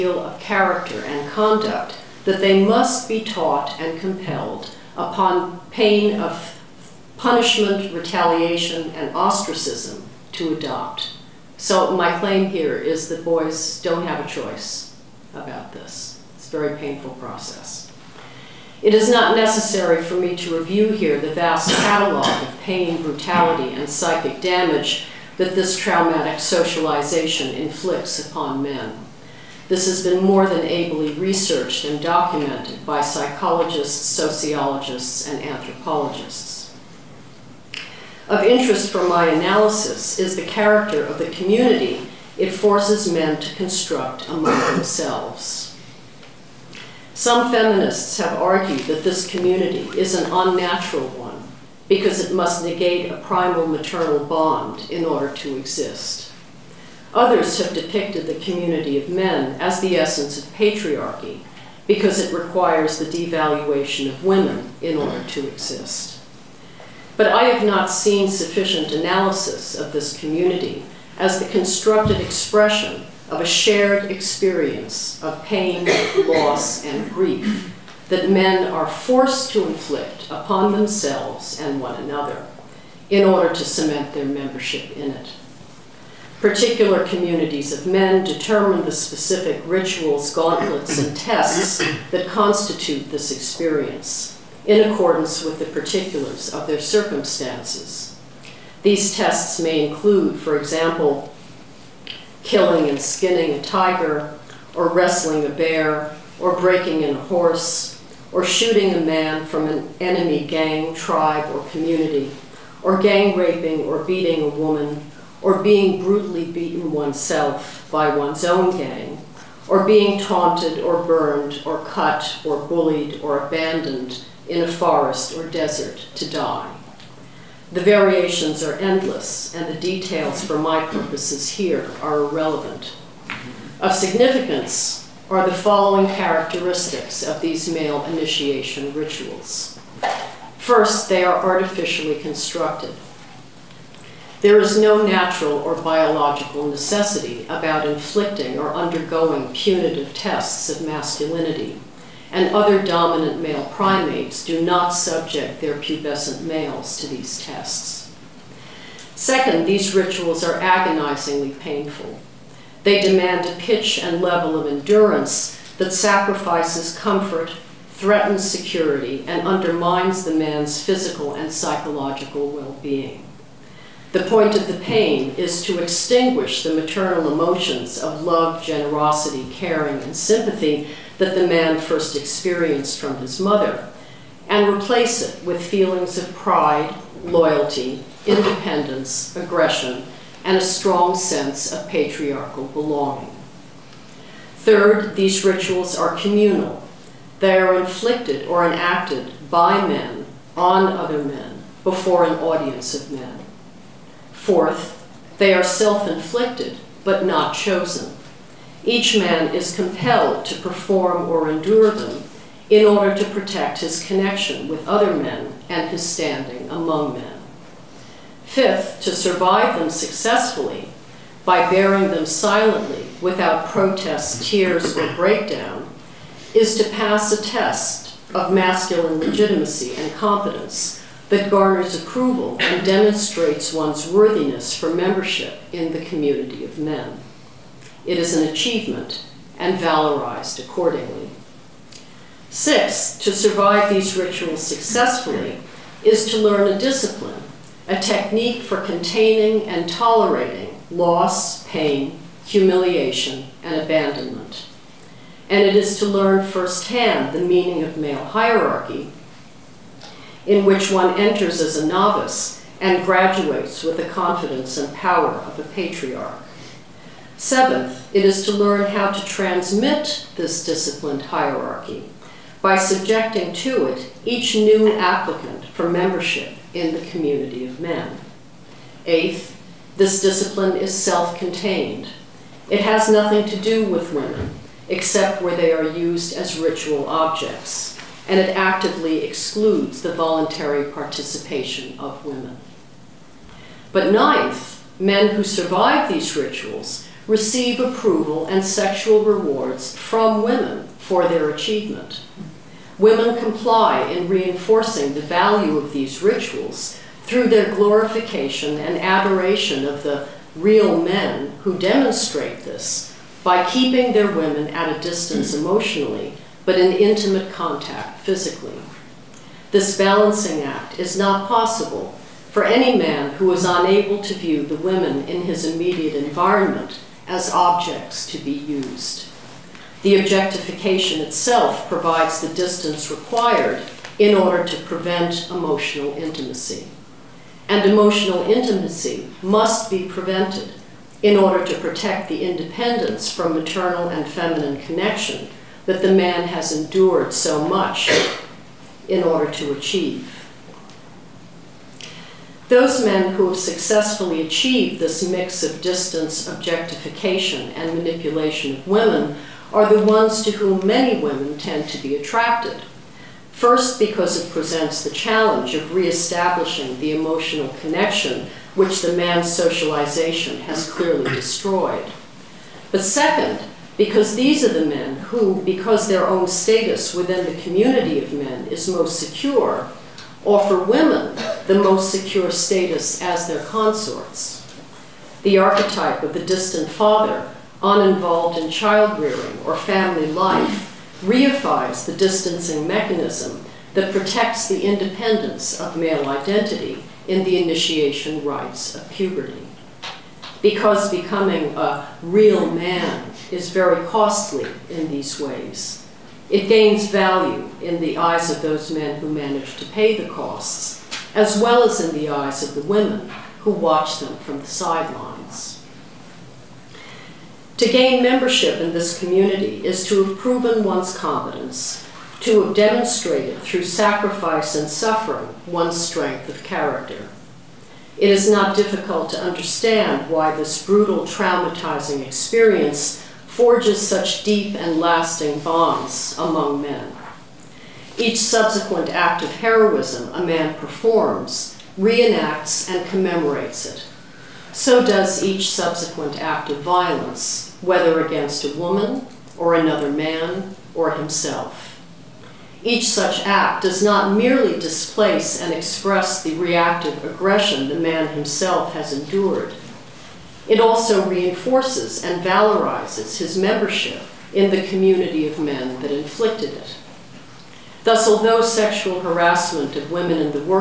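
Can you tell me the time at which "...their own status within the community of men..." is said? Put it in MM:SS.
06:16.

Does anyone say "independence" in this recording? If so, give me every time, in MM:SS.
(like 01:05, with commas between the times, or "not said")
03:08, 05:42, 06:34.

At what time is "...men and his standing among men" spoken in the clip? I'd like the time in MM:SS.
03:35.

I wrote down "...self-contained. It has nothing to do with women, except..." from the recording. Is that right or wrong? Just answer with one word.
right.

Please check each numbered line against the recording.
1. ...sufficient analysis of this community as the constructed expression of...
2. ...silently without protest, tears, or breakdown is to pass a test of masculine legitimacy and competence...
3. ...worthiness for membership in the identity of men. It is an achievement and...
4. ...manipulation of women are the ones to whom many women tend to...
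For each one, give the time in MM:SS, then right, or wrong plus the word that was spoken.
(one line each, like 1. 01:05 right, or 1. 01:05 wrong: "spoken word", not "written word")
1. 01:08 right
2. 03:42 right
3. 03:54 wrong: "community", not "identity"
4. 05:57 right.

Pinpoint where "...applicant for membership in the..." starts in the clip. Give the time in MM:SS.
04:34.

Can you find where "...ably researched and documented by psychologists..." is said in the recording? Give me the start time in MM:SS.
00:30.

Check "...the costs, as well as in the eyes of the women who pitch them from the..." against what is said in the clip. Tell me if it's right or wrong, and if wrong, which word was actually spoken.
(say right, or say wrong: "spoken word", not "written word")
wrong: "watch", not "pitch".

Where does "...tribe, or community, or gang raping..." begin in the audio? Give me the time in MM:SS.
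01:50.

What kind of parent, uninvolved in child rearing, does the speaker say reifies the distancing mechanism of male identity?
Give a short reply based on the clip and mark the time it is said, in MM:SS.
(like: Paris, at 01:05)
the distant father, at 06:26.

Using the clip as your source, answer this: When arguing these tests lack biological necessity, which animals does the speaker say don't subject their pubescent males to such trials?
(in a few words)
dominant male primates.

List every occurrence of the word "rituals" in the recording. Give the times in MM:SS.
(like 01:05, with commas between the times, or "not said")
01:29, 02:18, 02:39, 03:15, 04:04, 04:46, 04:56, 05:06.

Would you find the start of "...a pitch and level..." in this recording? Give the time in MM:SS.
02:43.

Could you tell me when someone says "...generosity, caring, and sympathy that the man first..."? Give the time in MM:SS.
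02:58.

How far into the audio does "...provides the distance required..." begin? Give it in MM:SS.
05:31.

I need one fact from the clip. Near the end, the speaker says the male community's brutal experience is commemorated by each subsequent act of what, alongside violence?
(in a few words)
heroism.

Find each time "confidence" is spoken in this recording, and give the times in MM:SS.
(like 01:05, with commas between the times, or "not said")
04:24.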